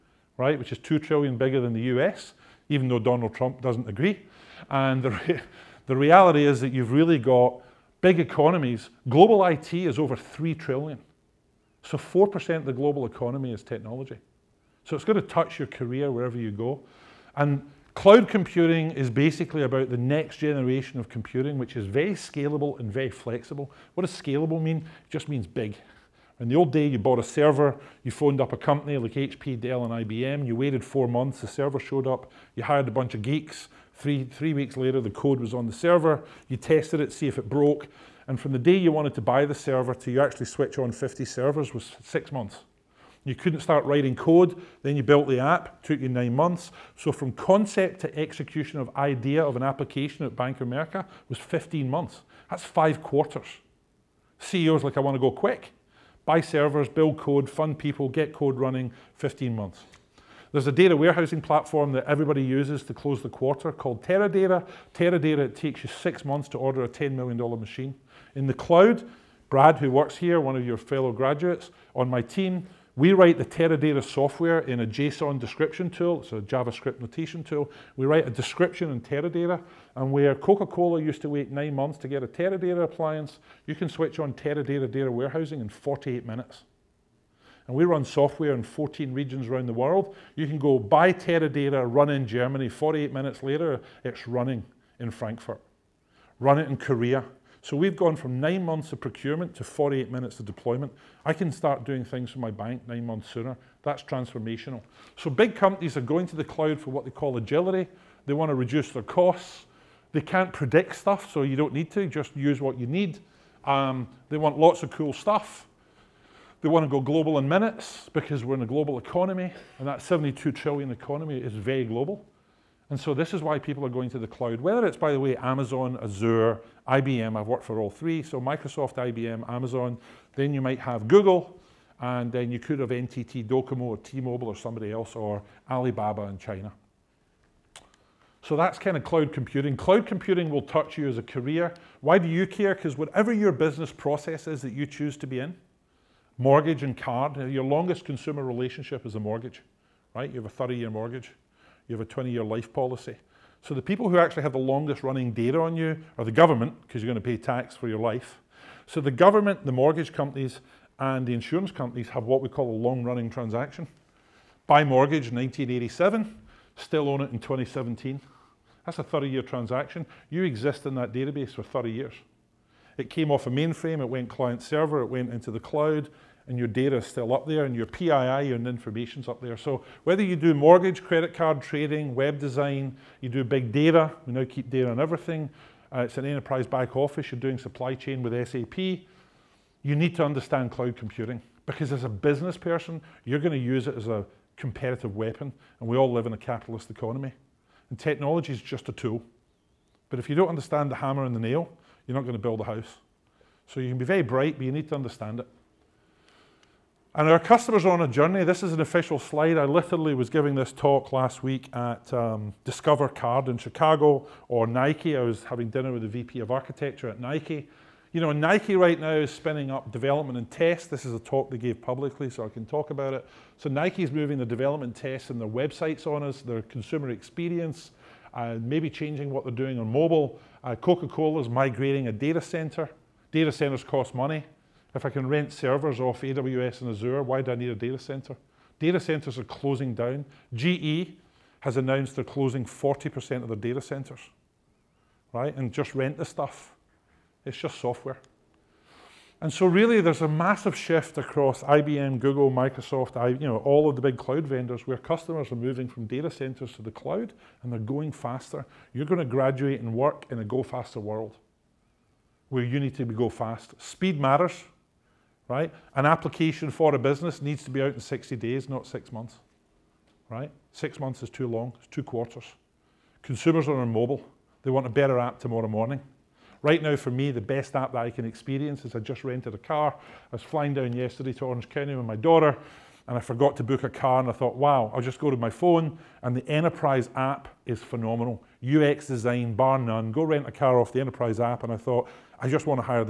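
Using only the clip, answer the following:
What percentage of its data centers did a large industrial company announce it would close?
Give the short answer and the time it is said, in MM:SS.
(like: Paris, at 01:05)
40%, at 04:02.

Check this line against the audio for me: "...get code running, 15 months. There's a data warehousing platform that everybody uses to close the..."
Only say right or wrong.
right.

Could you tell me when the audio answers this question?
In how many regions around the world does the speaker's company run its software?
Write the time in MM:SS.
01:28.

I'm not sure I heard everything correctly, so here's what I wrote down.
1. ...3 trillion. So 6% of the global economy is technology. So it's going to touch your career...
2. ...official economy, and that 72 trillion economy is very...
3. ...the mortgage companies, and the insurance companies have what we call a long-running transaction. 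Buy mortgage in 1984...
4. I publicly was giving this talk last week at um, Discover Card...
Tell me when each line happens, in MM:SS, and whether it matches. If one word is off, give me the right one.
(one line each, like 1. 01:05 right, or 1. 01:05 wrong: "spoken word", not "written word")
1. 00:10 wrong: "4", not "6"
2. 01:58 wrong: "global", not "official"
3. 02:39 wrong: "1987", not "1984"
4. 03:29 wrong: "literally", not "publicly".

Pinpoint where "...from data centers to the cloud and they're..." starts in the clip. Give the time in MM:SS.
04:15.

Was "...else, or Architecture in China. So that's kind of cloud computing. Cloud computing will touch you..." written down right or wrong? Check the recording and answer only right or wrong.
wrong.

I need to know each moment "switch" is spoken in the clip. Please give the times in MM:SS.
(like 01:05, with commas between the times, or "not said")
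00:40, 01:23.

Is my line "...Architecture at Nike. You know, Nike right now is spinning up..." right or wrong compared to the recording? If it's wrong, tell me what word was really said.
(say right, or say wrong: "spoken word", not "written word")
right.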